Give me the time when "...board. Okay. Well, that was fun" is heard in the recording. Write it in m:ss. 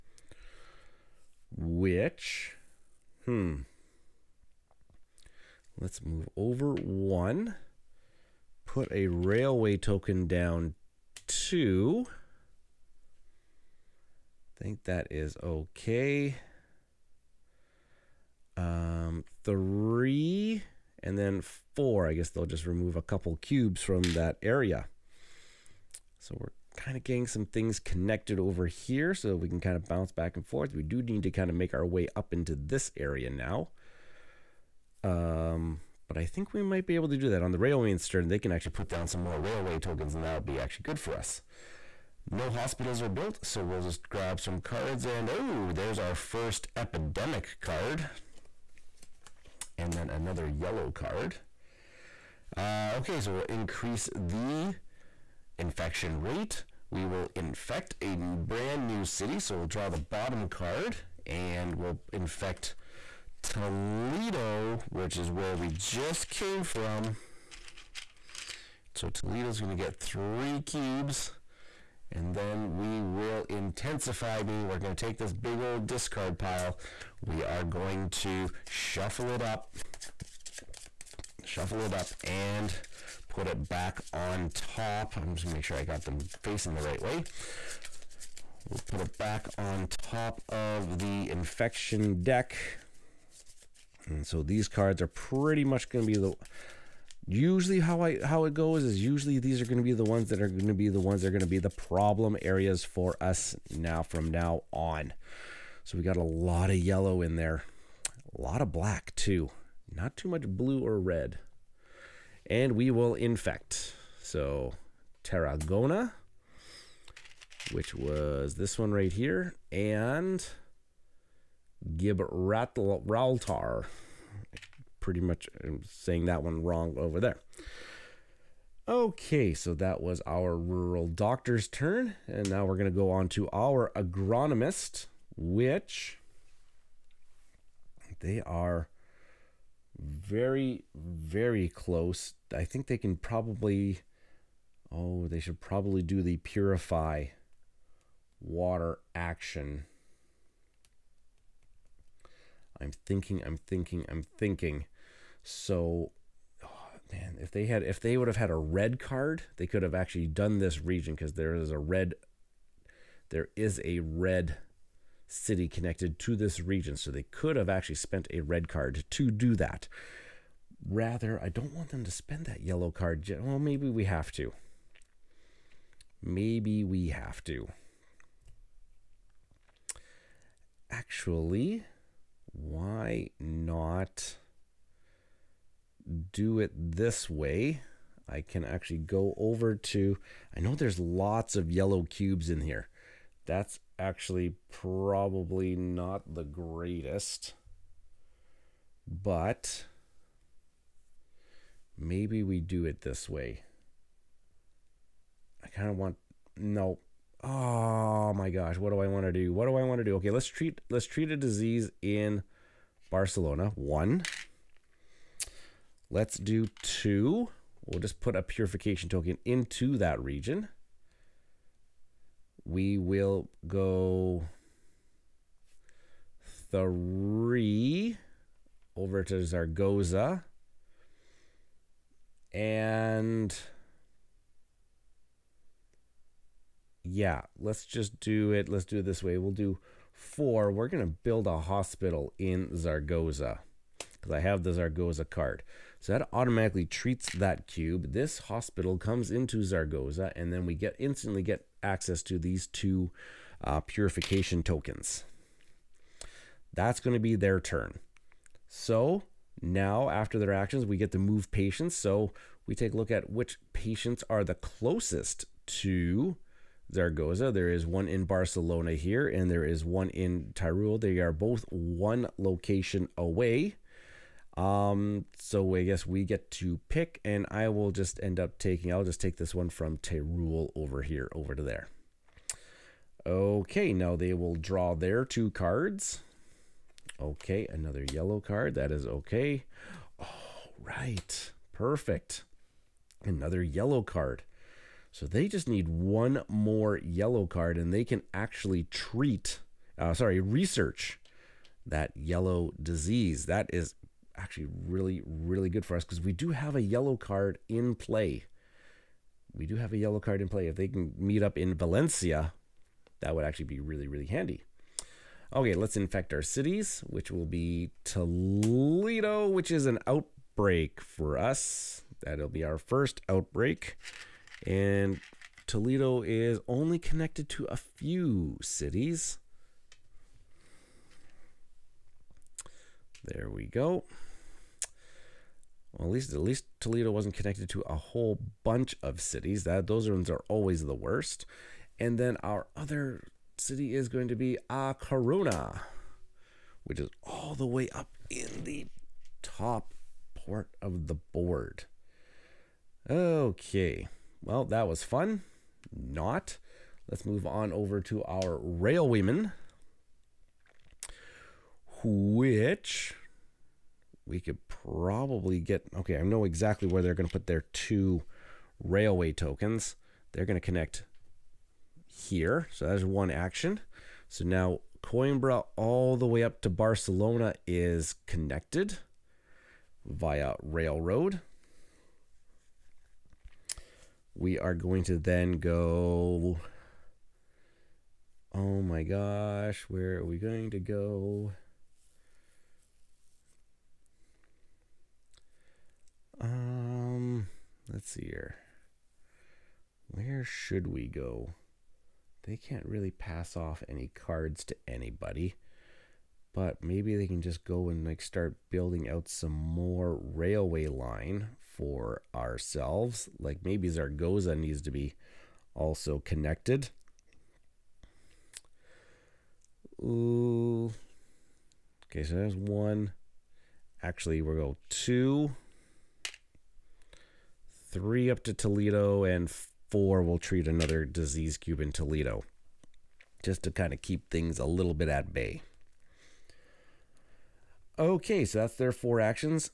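5:51.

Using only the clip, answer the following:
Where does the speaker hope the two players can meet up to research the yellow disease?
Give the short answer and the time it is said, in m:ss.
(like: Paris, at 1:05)
Valencia, at 5:11.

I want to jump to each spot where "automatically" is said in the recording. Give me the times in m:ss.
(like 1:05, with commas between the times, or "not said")
4:06.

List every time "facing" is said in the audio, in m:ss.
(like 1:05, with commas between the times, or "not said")
1:26.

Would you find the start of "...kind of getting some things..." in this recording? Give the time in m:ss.
0:26.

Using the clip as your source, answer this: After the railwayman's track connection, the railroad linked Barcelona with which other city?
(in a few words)
Coimbra.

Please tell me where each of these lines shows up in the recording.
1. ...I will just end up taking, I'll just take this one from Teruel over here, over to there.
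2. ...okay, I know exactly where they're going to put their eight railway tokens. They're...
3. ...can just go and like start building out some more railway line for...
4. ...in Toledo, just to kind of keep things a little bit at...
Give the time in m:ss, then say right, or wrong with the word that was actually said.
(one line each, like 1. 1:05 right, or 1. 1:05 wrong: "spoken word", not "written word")
1. 4:37 right
2. 6:05 wrong: "two", not "eight"
3. 6:47 right
4. 7:11 right.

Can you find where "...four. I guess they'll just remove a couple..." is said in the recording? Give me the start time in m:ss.
0:21.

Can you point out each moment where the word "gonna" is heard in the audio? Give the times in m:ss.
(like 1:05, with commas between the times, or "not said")
1:25, 1:35.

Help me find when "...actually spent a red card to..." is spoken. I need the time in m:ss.
2:47.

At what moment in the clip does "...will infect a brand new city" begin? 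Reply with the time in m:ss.
0:57.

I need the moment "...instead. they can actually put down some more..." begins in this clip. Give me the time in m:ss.
0:37.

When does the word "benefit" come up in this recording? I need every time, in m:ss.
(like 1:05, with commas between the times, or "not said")
not said.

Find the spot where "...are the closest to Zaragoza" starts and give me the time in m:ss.
4:24.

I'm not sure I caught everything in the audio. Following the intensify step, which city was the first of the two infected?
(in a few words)
Tarragona.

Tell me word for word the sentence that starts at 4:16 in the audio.
That's going to be their turn.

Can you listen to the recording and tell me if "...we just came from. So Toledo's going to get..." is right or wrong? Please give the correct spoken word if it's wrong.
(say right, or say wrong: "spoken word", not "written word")
right.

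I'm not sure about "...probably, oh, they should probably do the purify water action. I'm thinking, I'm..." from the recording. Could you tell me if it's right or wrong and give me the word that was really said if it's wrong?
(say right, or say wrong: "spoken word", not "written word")
right.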